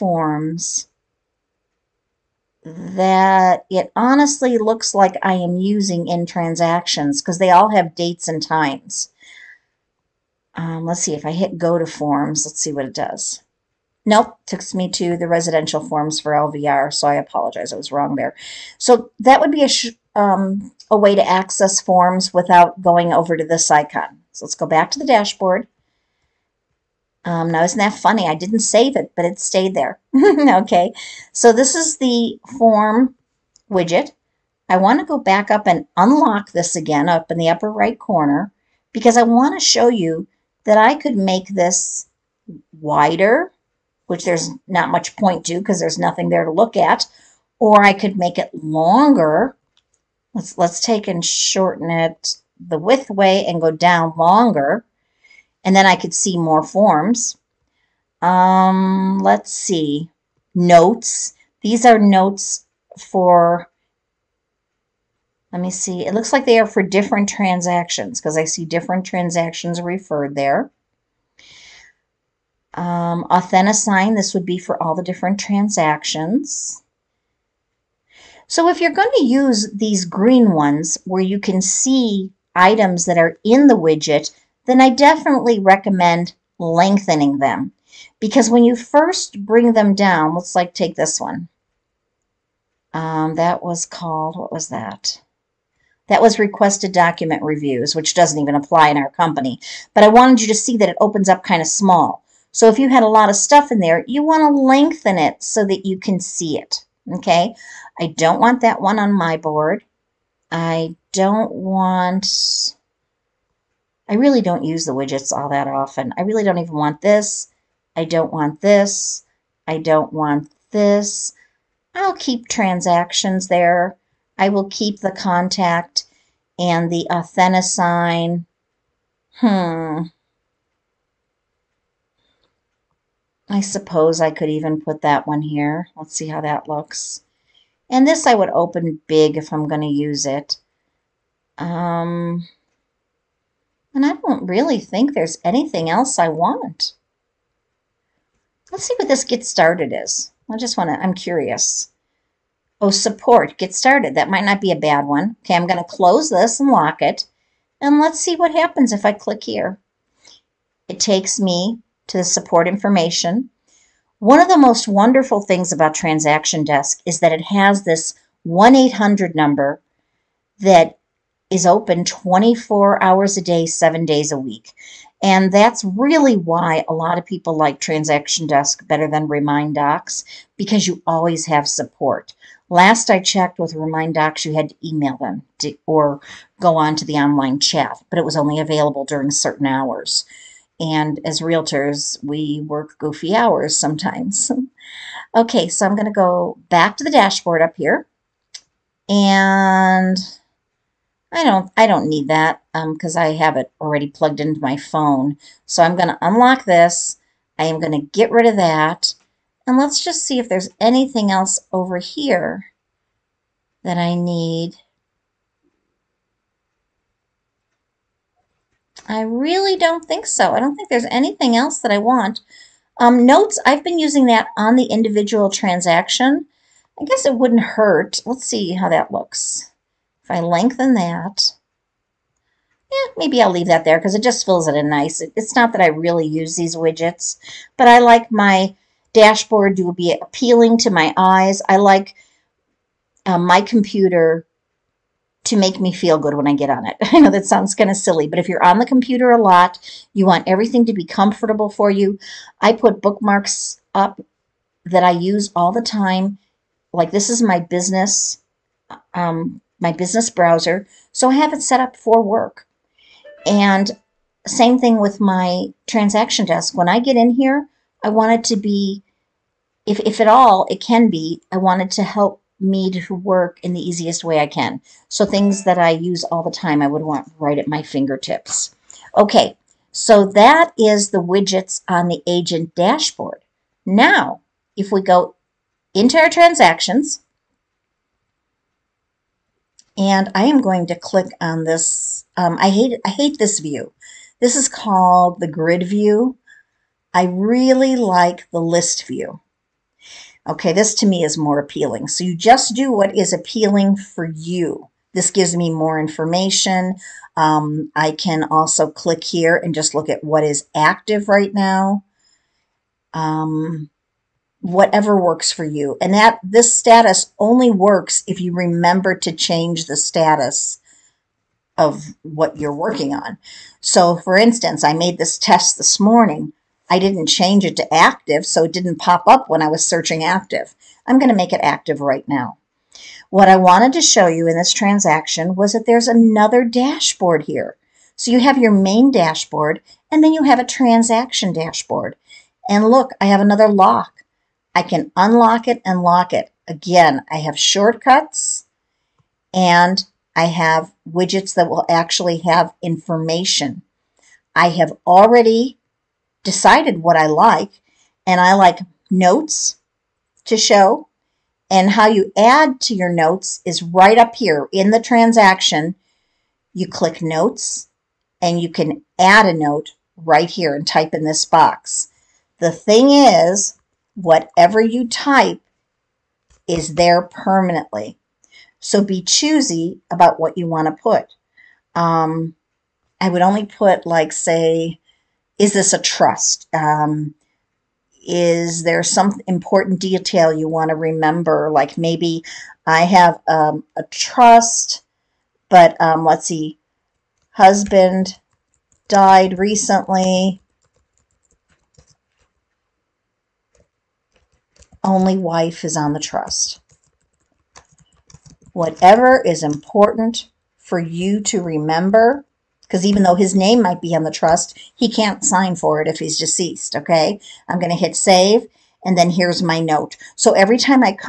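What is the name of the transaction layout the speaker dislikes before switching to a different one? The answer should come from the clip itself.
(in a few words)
Grid view.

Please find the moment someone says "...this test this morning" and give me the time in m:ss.
5:25.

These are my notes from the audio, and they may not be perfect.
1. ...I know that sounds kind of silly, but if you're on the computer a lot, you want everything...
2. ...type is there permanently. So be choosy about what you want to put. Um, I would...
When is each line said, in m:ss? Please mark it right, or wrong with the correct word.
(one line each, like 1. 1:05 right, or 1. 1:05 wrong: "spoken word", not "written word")
1. 4:07 right
2. 6:15 right.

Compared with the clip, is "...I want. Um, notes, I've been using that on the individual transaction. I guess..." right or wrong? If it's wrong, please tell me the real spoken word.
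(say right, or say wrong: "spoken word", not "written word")
right.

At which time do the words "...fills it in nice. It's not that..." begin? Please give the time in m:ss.
3:54.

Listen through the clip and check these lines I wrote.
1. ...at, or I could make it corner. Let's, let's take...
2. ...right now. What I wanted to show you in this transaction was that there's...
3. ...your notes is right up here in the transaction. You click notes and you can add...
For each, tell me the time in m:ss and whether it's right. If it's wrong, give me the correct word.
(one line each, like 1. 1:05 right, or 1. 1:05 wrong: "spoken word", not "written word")
1. 0:46 wrong: "longer", not "corner"
2. 5:32 right
3. 6:02 right.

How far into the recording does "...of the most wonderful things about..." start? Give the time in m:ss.
2:44.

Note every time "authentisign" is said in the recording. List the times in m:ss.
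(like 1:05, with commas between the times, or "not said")
1:13, 2:07.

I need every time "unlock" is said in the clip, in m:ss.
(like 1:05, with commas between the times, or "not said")
0:35, 3:26, 5:45.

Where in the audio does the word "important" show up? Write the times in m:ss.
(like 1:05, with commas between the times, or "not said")
6:29, 6:49.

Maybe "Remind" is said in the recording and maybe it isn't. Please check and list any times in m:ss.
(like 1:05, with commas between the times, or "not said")
2:59, 3:03.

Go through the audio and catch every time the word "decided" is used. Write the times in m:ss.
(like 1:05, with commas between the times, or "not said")
5:56.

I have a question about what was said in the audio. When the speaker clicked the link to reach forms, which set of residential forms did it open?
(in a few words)
LVR.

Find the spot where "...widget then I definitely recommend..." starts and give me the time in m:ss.
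1:23.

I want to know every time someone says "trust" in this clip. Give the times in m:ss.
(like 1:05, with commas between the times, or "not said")
6:26, 6:34, 6:46, 6:54.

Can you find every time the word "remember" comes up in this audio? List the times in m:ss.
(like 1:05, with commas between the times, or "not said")
5:18, 6:30, 6:51.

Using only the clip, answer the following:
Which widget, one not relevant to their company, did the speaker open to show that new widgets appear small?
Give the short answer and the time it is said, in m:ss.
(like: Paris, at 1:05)
Requested document reviews, at 1:36.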